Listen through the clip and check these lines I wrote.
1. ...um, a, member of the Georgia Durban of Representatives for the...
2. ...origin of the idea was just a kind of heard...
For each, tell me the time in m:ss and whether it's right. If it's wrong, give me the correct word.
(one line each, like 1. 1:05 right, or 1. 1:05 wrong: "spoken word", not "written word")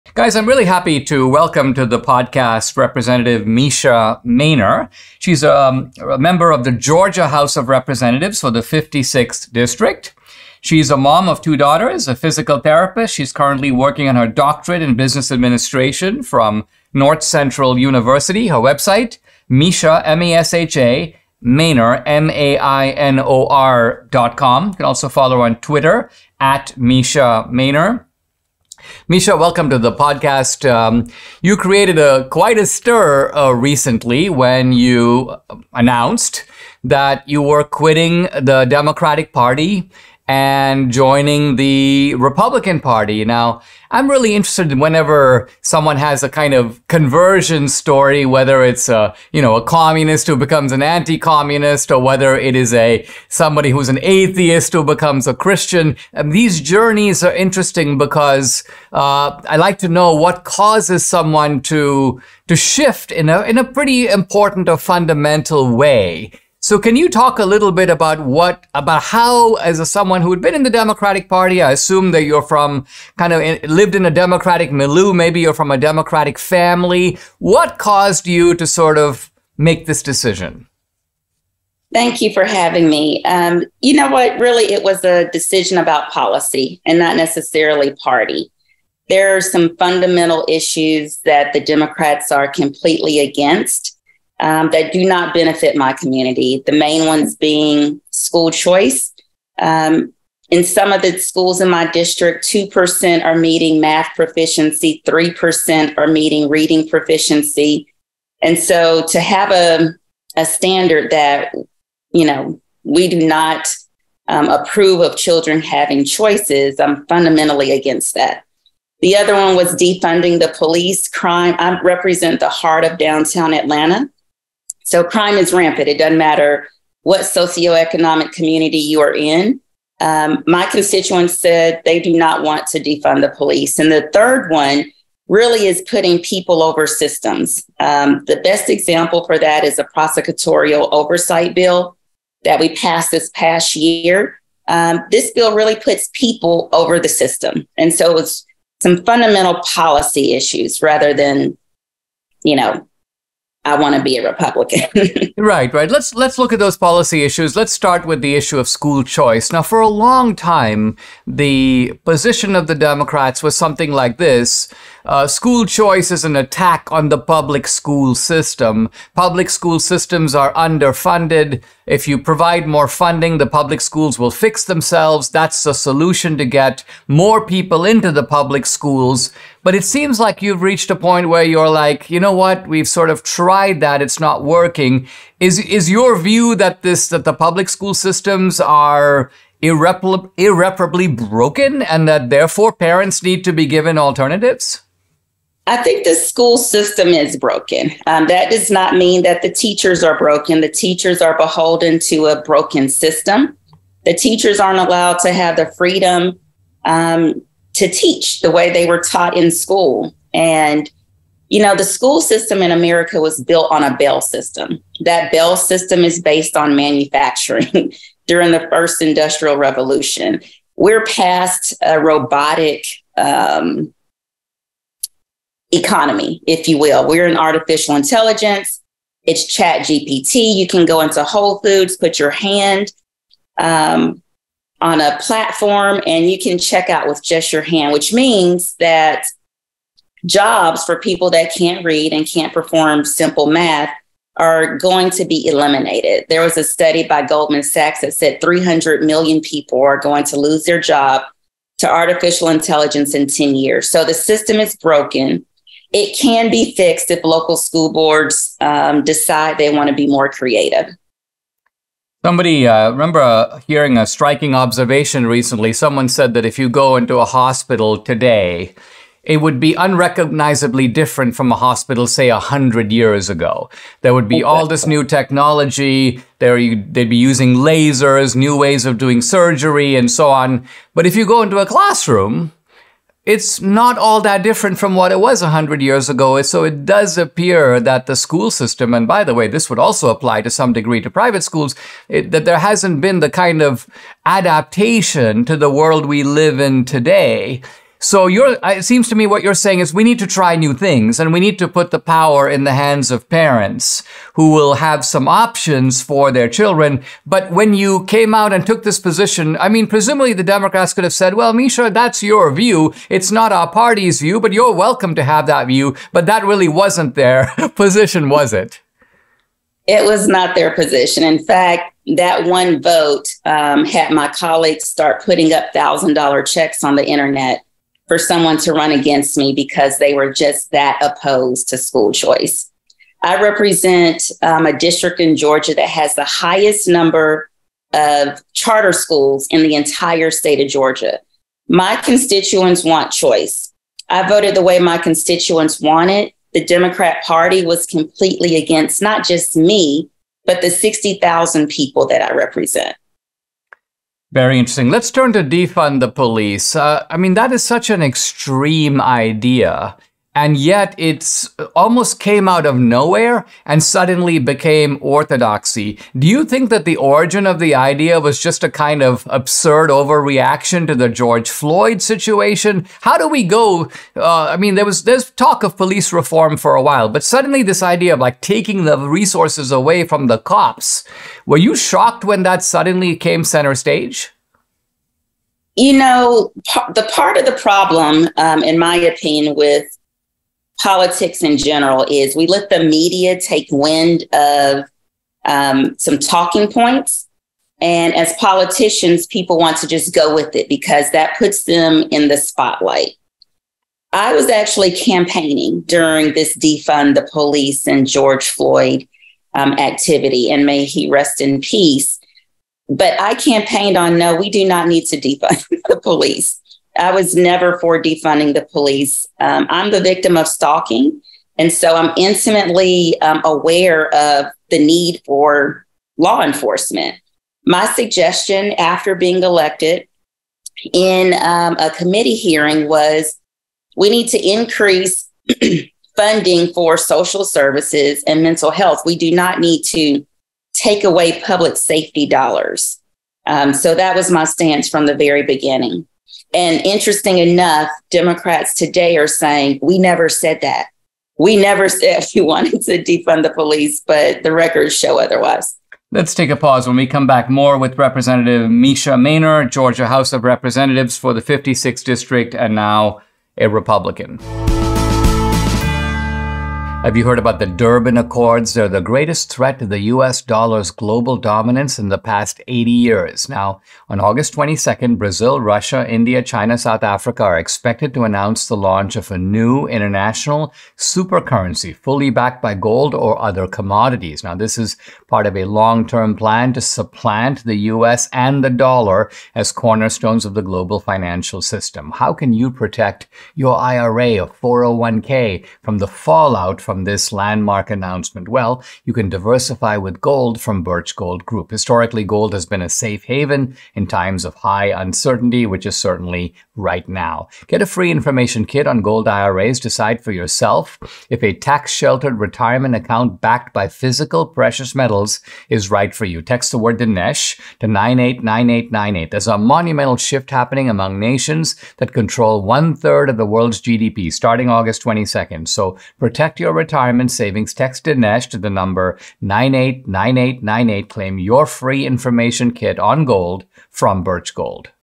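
1. 0:05 wrong: "House", not "Durban"
2. 6:06 wrong: "absurd", not "heard".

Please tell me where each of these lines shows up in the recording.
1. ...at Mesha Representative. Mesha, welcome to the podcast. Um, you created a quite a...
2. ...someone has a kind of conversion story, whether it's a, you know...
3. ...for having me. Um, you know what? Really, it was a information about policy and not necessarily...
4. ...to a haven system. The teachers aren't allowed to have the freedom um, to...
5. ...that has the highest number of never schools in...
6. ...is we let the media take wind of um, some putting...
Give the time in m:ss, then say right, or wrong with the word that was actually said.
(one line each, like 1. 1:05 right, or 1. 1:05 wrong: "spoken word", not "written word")
1. 0:26 wrong: "Mainor", not "Representative"
2. 0:45 right
3. 1:22 wrong: "decision", not "information"
4. 3:22 wrong: "broken", not "haven"
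5. 5:35 wrong: "charter", not "never"
6. 6:32 wrong: "talking", not "putting".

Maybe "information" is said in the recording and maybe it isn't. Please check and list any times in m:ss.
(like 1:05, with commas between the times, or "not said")
8:28, 8:52.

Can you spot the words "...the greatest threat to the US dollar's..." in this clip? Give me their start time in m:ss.
7:48.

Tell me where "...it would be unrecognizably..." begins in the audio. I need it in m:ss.
4:29.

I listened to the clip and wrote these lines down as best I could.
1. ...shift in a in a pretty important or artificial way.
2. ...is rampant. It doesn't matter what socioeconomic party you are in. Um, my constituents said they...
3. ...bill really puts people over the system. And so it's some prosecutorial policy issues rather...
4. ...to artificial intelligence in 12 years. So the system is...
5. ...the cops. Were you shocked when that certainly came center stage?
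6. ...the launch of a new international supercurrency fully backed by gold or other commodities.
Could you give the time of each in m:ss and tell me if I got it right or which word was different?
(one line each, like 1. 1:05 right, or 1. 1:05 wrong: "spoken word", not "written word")
1. 1:02 wrong: "fundamental", not "artificial"
2. 2:05 wrong: "community", not "party"
3. 2:25 wrong: "fundamental", not "prosecutorial"
4. 4:11 wrong: "10", not "12"
5. 6:20 wrong: "suddenly", not "certainly"
6. 7:58 right.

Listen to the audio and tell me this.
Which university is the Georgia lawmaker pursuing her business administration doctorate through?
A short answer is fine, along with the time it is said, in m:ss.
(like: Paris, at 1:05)
Northcentral University, at 0:16.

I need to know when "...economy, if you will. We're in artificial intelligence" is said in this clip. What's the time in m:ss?
3:45.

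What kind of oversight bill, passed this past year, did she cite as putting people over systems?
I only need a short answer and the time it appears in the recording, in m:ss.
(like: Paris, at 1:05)
prosecutorial oversight, at 2:19.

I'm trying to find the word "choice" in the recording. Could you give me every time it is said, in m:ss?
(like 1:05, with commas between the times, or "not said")
1:38, 1:56, 2:39, 2:45, 5:32, 5:43.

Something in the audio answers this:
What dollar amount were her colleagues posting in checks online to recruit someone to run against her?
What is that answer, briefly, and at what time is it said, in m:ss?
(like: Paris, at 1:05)
$1,000, at 5:25.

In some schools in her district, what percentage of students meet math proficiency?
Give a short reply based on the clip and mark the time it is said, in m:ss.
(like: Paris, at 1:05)
2%, at 1:42.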